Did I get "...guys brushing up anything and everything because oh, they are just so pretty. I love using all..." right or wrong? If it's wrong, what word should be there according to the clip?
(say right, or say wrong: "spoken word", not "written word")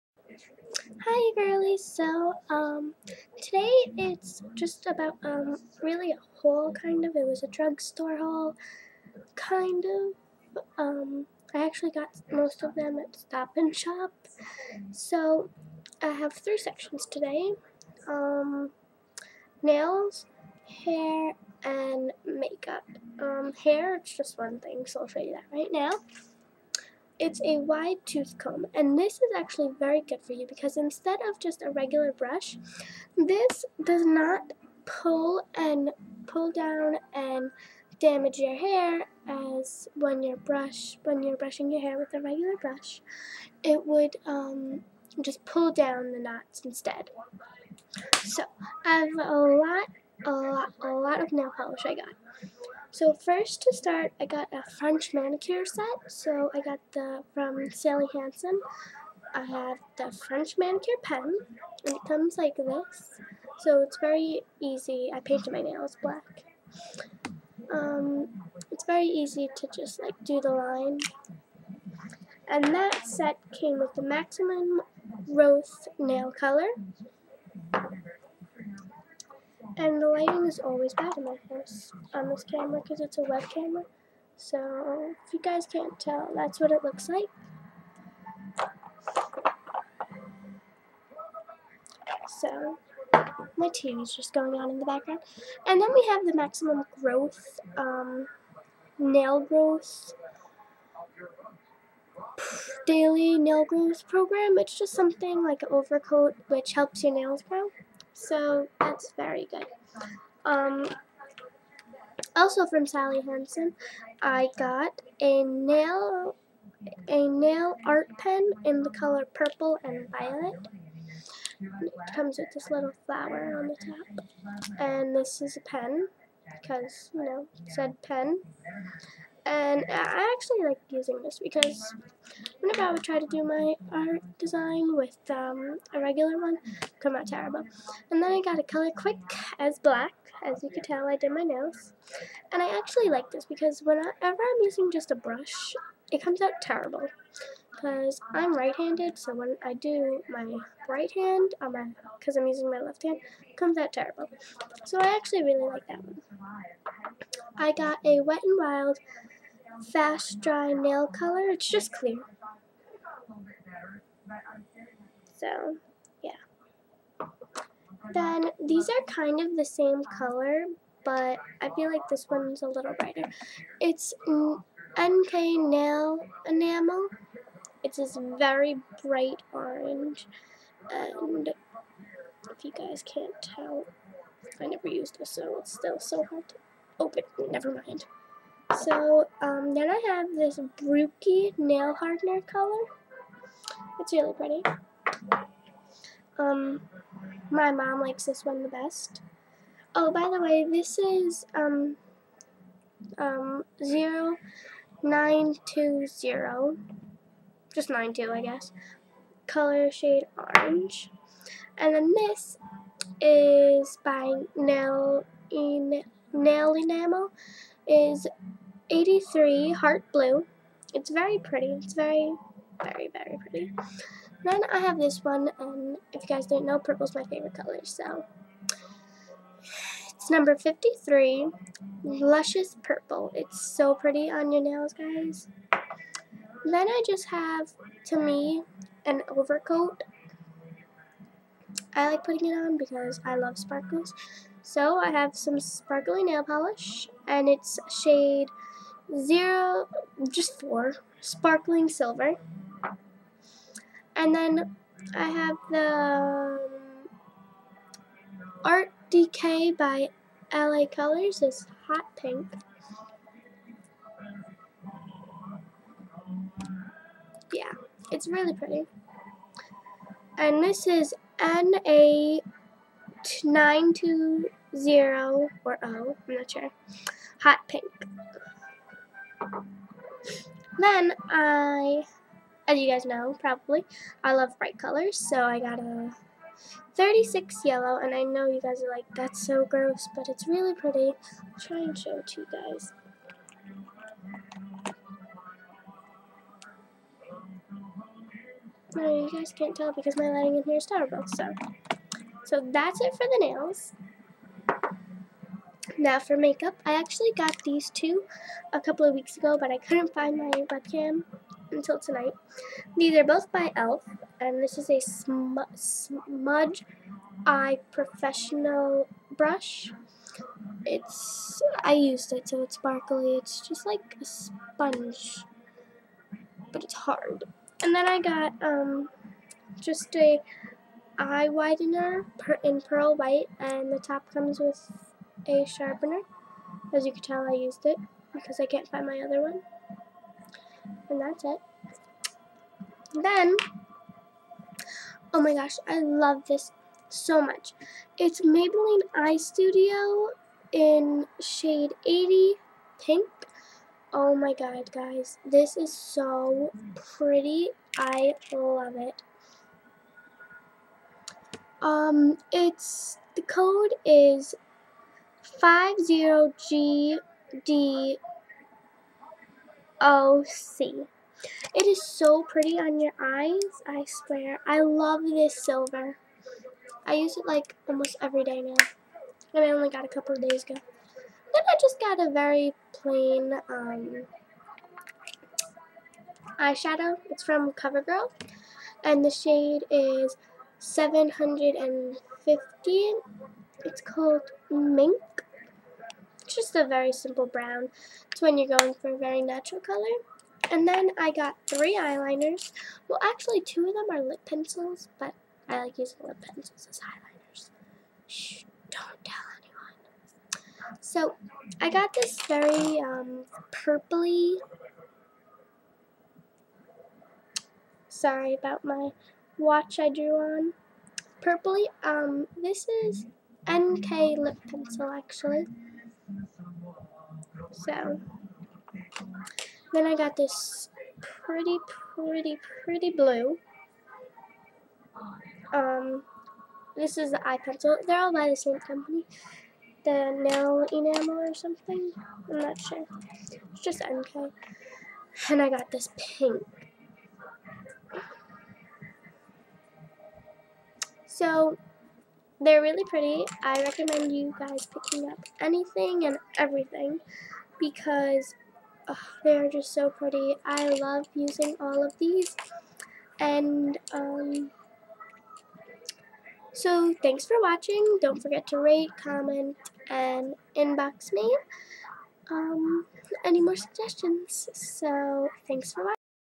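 wrong: "picking", not "brushing".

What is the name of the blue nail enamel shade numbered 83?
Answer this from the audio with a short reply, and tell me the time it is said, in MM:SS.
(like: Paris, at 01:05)
heart blue, at 03:39.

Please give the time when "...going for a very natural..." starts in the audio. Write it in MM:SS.
06:38.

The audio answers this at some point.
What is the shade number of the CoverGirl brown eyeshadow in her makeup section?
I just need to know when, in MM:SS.
06:30.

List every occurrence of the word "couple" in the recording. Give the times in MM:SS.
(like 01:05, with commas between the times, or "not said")
05:08, 06:20.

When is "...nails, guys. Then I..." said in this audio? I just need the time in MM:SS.
03:54.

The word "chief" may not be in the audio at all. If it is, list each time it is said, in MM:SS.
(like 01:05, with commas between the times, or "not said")
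not said.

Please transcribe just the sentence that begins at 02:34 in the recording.
So I actually really like that one.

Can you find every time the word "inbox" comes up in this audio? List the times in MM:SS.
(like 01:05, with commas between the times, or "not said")
07:50.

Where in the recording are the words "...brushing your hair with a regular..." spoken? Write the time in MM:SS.
00:41.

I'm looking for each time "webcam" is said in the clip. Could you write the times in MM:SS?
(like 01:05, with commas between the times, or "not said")
05:10.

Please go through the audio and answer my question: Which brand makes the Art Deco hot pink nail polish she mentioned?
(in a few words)
LA Colors.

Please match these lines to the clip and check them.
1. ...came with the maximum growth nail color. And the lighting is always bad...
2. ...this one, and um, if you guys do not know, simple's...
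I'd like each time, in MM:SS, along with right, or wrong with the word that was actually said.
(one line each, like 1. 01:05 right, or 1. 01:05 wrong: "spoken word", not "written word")
1. 01:13 right
2. 03:44 wrong: "purple", not "simple".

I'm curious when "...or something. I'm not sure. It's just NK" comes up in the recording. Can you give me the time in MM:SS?
07:21.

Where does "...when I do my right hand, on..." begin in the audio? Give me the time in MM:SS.
02:29.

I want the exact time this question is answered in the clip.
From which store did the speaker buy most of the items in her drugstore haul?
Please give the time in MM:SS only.
00:13.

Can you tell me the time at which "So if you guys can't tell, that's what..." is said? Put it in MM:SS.
01:24.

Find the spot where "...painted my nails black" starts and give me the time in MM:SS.
01:05.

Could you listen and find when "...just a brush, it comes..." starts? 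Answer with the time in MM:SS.
02:24.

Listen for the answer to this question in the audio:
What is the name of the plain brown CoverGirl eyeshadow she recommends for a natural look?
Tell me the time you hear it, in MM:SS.
06:34.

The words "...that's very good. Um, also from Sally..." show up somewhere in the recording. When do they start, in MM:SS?
01:48.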